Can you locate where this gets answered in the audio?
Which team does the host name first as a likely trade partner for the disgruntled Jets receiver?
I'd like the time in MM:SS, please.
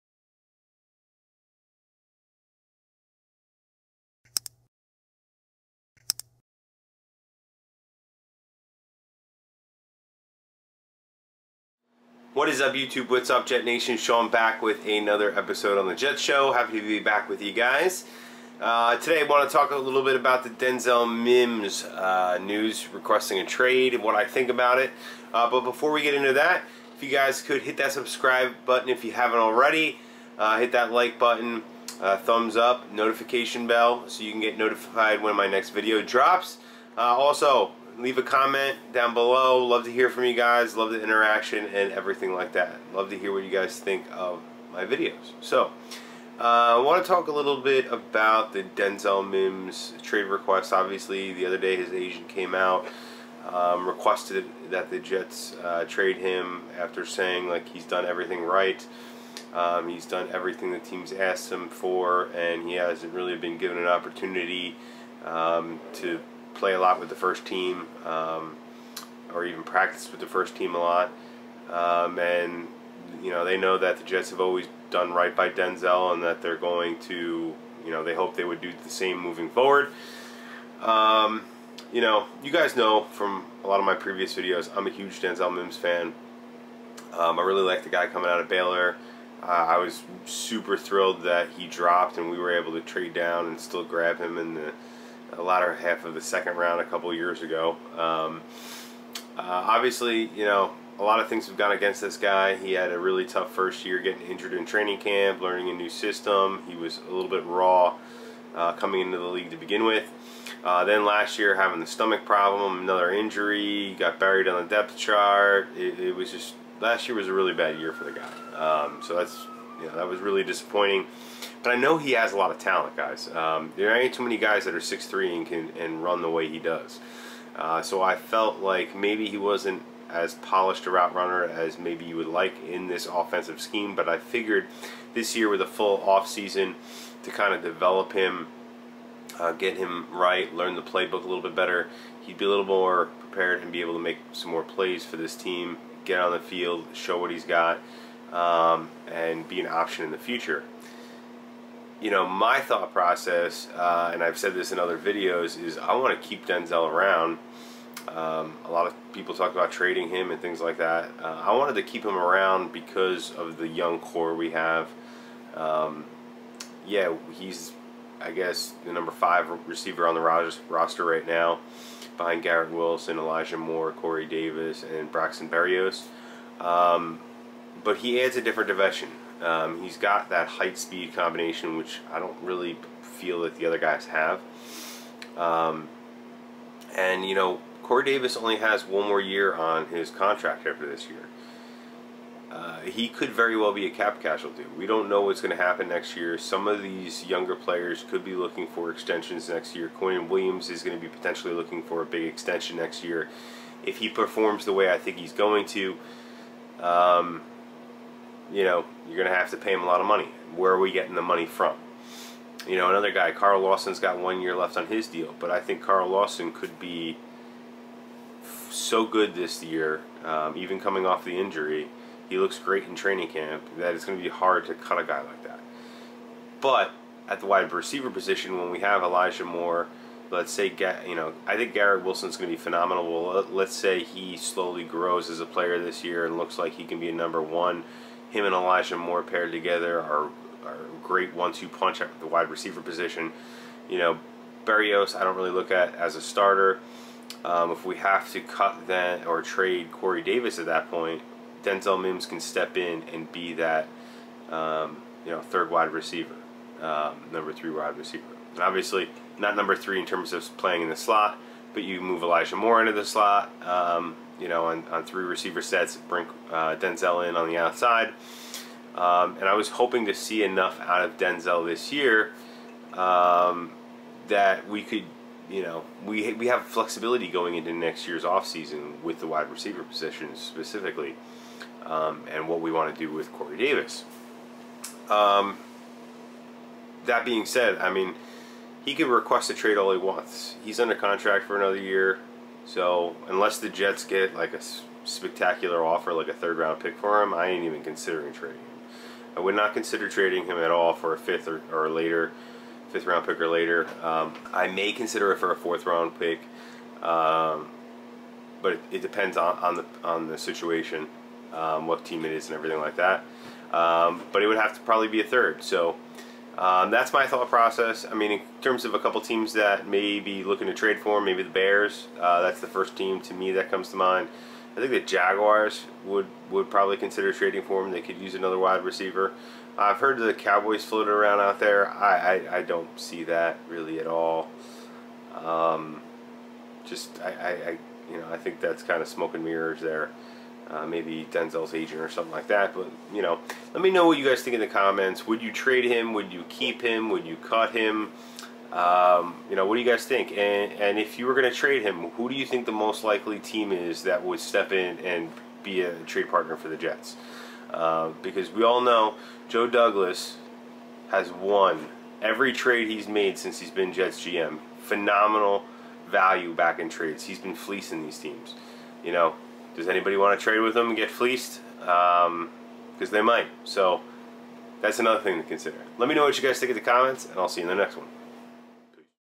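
05:21.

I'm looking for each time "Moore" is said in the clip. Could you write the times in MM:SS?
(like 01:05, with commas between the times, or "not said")
02:53, 03:49, 03:58, 04:22.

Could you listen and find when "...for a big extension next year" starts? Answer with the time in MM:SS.
03:21.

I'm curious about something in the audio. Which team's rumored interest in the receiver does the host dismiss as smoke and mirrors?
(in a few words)
Cowboys.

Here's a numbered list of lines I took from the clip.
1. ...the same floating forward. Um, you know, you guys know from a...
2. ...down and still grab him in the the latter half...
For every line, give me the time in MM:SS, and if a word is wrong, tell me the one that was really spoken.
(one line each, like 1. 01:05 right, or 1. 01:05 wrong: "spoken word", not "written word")
1. 01:18 wrong: "moving", not "floating"
2. 01:33 right.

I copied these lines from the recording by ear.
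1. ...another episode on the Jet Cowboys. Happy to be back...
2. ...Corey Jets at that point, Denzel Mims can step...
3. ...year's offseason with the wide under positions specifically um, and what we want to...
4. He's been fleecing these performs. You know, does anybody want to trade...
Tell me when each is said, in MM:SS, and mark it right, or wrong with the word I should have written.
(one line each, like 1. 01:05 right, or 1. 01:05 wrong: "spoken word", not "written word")
1. 00:14 wrong: "Show", not "Cowboys"
2. 04:09 wrong: "Davis", not "Jets"
3. 04:38 wrong: "receiver", not "under"
4. 06:07 wrong: "teams", not "performs".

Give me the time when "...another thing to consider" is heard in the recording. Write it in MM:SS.
06:14.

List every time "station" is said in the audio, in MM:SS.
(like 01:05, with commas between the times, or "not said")
not said.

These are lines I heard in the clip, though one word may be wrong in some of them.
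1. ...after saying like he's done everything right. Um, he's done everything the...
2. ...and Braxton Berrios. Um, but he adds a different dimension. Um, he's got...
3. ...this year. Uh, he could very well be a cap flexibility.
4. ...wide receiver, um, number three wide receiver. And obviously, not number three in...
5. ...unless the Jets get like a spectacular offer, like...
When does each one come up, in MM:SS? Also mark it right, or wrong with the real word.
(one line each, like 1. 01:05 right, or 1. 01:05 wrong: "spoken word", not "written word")
1. 00:56 right
2. 02:54 right
3. 03:10 wrong: "casualty", not "flexibility"
4. 04:15 right
5. 04:53 right.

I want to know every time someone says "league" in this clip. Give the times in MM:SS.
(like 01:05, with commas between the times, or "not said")
01:49.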